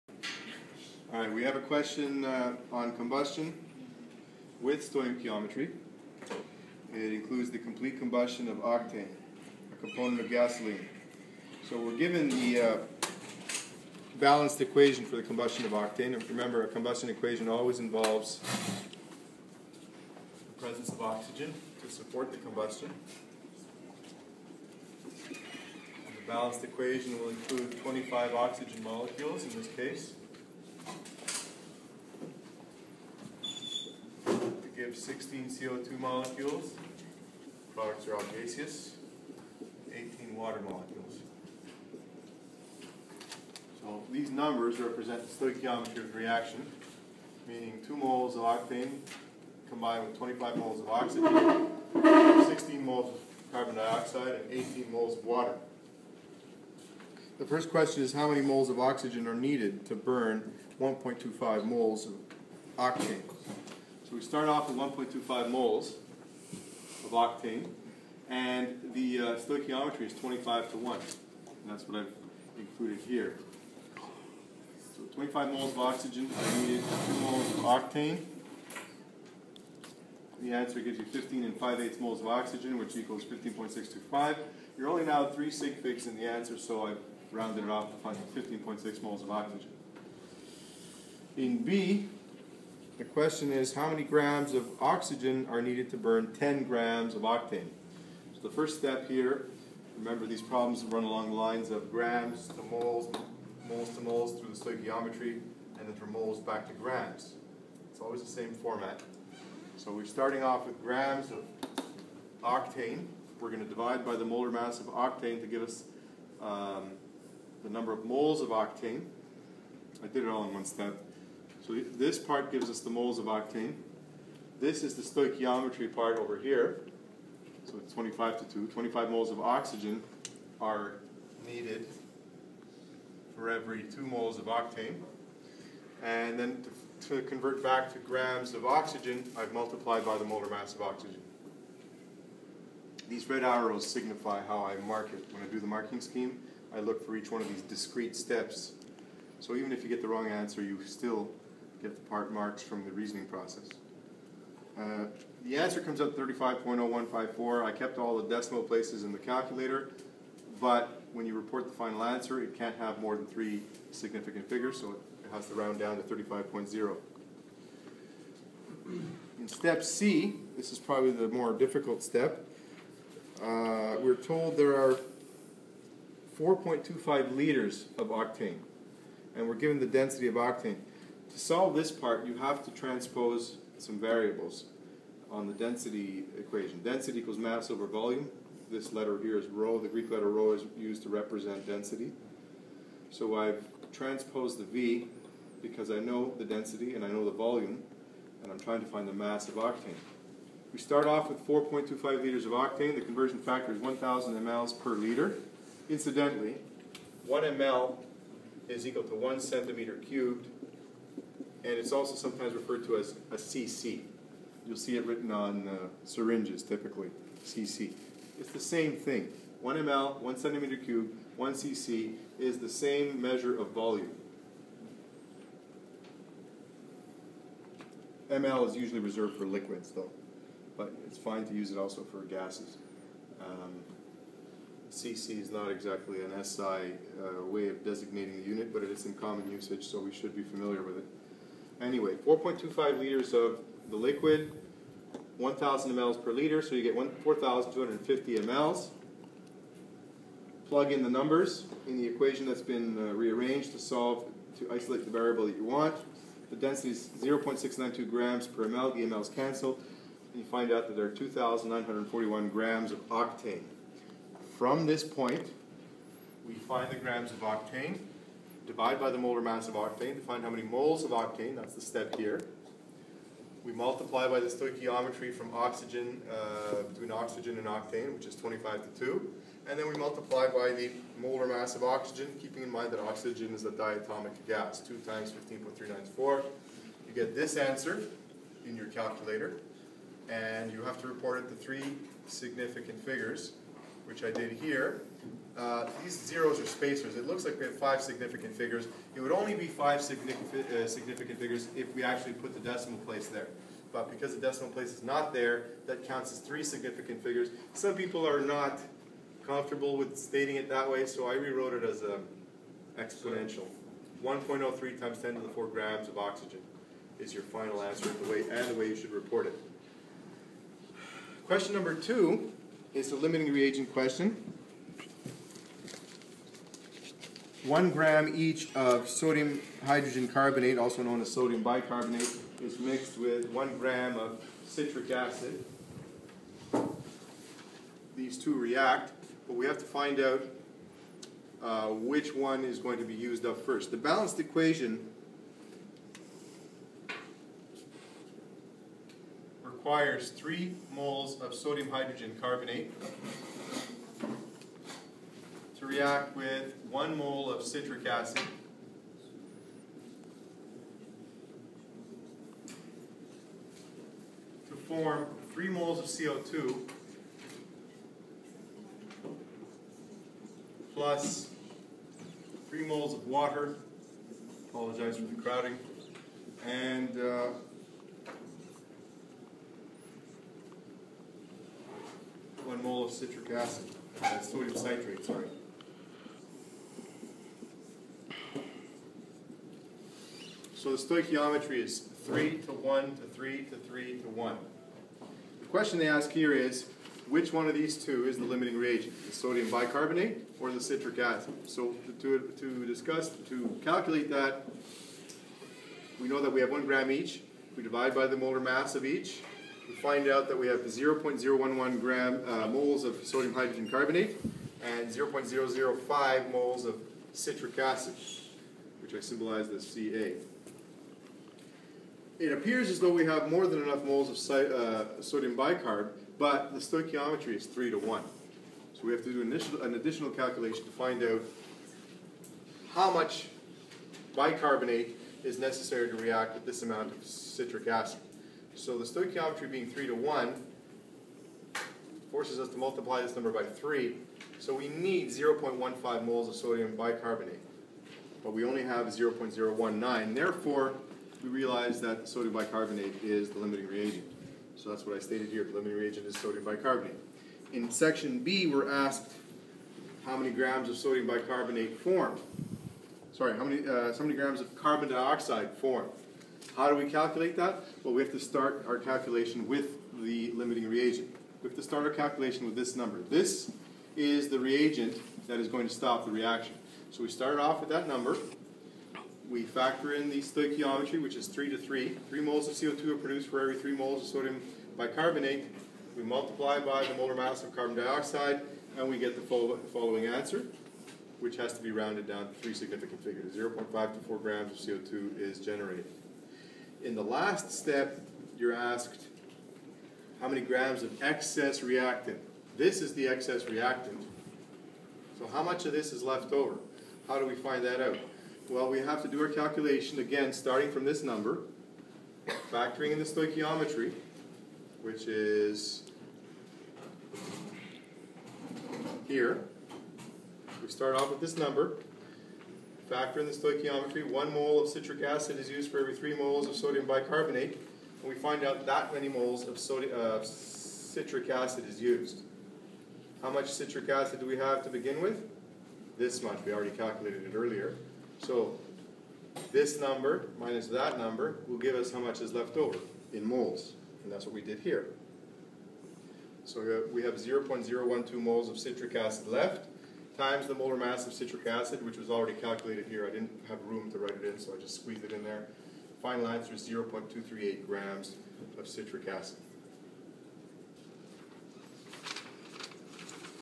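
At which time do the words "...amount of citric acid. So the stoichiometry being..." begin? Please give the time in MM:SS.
07:16.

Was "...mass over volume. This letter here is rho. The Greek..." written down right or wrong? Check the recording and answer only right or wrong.
right.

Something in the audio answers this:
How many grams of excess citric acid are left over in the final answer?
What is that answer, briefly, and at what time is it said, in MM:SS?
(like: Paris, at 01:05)
0.238 grams, at 09:16.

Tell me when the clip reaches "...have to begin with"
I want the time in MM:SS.
08:54.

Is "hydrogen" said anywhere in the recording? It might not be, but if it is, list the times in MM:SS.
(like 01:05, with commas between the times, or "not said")
05:29, 05:51, 06:53.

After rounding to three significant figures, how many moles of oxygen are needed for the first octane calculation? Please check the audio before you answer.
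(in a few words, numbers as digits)
15.6.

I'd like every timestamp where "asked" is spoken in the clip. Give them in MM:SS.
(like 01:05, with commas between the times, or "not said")
07:38, 08:18.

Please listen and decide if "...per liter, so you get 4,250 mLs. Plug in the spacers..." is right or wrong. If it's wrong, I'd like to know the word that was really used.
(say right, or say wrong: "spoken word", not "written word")
wrong: "numbers", not "spacers".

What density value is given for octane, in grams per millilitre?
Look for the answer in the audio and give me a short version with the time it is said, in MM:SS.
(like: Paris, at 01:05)
0.692, at 04:17.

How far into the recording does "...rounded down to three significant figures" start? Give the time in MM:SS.
08:11.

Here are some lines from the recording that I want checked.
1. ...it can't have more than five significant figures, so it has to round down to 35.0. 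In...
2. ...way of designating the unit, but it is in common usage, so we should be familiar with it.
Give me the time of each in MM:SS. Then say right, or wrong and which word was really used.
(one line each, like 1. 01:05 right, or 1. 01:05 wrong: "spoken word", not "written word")
1. 02:42 wrong: "three", not "five"
2. 03:57 right.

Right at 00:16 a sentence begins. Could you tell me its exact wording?
And remember, a combustion equation always involves the presence of oxygen to support the combustion.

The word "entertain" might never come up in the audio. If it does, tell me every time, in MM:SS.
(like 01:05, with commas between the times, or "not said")
not said.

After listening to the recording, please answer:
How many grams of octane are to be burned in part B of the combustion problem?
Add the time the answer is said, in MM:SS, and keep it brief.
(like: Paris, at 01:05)
10 grams, at 01:36.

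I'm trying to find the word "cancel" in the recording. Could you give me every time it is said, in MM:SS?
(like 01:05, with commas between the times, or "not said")
04:19.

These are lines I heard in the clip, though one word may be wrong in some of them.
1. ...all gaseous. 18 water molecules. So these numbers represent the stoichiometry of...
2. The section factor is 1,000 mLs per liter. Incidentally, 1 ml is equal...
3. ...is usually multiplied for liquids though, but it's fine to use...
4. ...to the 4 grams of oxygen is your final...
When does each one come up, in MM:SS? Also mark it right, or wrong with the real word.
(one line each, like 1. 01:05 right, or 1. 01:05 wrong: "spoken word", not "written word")
1. 00:38 right
2. 03:22 wrong: "conversion", not "section"
3. 03:48 wrong: "reserved", not "multiplied"
4. 05:15 right.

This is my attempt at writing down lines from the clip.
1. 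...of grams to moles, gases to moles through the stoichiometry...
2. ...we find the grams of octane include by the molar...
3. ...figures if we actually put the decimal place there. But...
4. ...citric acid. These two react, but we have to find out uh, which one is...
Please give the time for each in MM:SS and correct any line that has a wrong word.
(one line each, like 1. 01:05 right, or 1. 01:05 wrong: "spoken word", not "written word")
1. 01:41 wrong: "moles", not "gases"
2. 04:26 wrong: "divide", not "include"
3. 05:01 right
4. 05:34 right.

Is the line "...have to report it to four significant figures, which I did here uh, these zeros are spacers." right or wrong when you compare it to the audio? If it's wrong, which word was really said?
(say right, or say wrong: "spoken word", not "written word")
wrong: "three", not "four".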